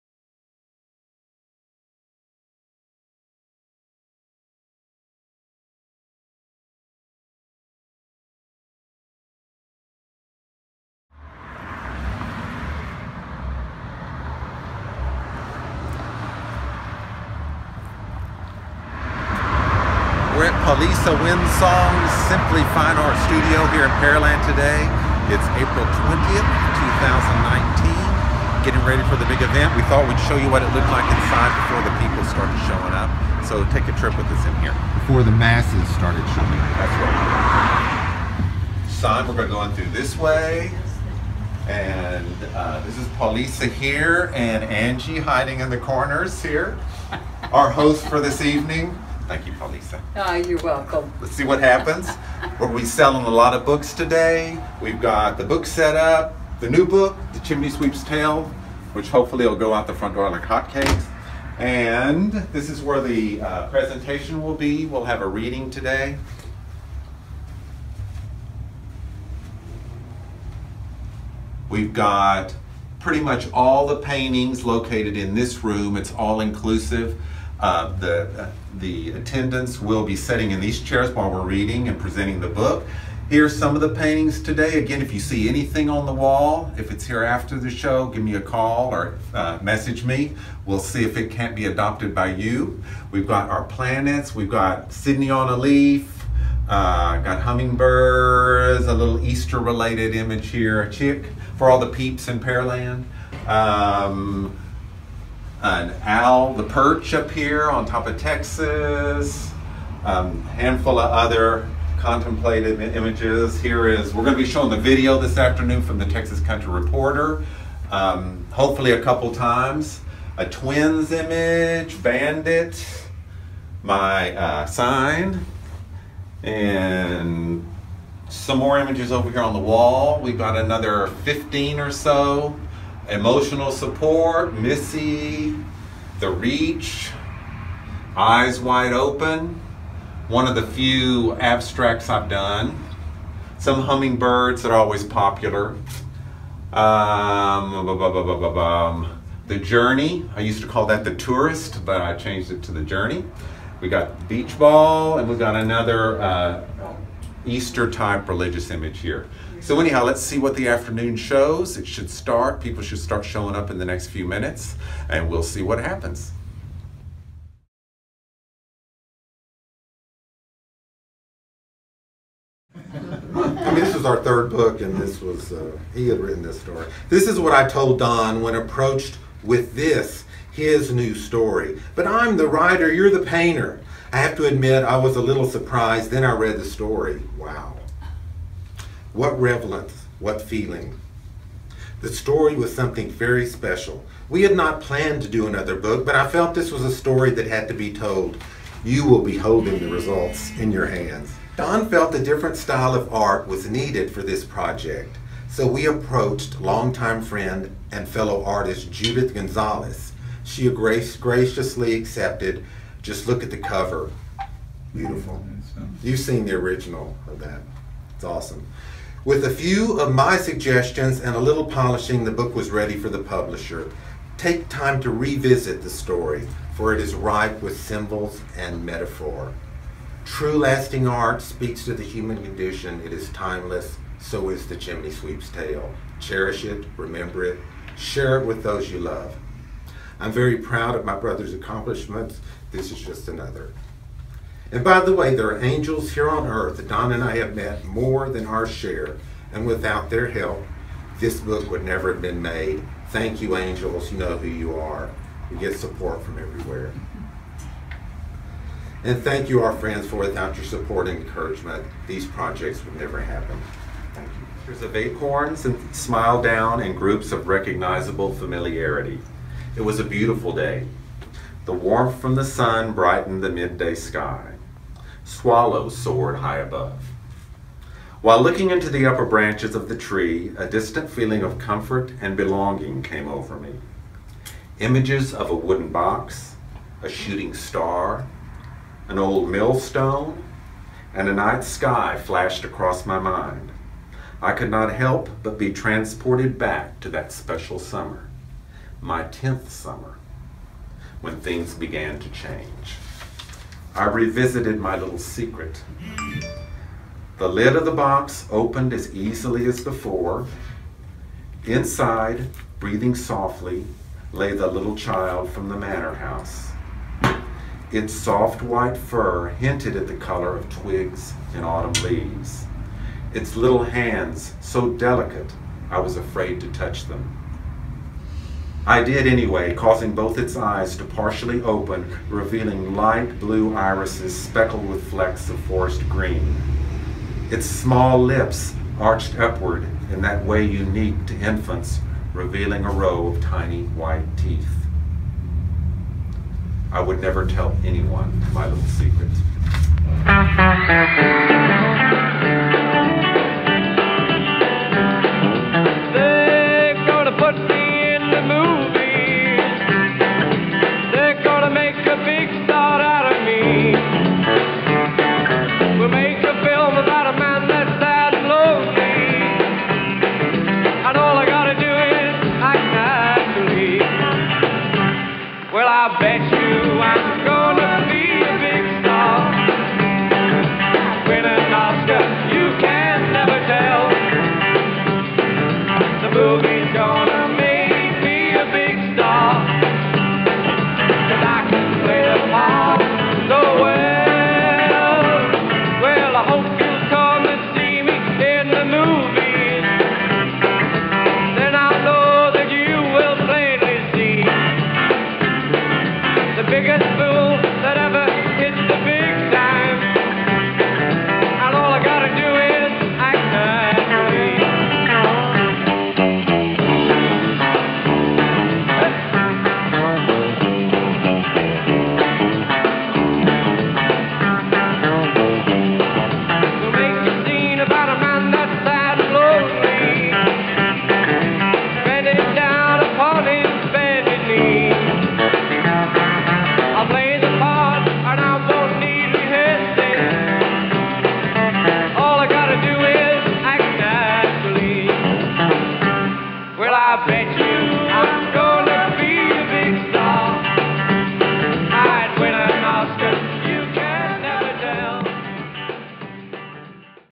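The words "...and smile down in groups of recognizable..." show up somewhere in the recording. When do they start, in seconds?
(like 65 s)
265 s.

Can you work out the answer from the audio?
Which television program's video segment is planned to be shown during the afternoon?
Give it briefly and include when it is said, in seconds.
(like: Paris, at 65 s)
Texas Country Reporter, at 116 s.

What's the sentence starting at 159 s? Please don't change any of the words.
So anyhow, let's see what the afternoon shows.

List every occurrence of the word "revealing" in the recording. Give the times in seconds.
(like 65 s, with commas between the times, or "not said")
332 s, 342 s.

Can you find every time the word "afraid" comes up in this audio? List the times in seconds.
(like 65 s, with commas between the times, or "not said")
326 s.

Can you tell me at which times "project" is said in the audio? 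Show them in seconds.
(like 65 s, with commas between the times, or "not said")
204 s, 262 s.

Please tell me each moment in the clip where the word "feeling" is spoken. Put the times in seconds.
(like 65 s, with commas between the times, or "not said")
190 s, 281 s.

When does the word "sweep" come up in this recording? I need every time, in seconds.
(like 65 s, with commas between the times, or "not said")
57 s, 235 s.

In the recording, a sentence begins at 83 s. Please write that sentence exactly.
Here's some of the paintings today.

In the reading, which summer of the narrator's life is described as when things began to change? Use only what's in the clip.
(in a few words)
10th summer.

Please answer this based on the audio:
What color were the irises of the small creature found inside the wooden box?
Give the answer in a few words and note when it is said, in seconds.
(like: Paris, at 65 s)
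light blue, at 332 s.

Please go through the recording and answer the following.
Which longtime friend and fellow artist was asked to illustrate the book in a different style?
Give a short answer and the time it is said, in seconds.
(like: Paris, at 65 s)
Judith Gonzalez, at 208 s.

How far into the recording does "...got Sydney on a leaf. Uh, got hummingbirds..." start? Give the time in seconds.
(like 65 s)
94 s.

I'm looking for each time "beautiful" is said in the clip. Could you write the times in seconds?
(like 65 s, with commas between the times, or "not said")
214 s, 270 s.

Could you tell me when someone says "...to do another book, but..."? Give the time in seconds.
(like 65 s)
195 s.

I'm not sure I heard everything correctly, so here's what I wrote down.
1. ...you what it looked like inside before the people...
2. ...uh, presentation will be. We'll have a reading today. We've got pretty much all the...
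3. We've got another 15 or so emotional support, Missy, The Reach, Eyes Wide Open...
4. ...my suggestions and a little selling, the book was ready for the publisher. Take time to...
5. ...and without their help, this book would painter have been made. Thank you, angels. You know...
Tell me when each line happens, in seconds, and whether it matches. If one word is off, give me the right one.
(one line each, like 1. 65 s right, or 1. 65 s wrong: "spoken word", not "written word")
1. 30 s right
2. 63 s right
3. 130 s right
4. 220 s wrong: "polishing", not "selling"
5. 249 s wrong: "never", not "painter".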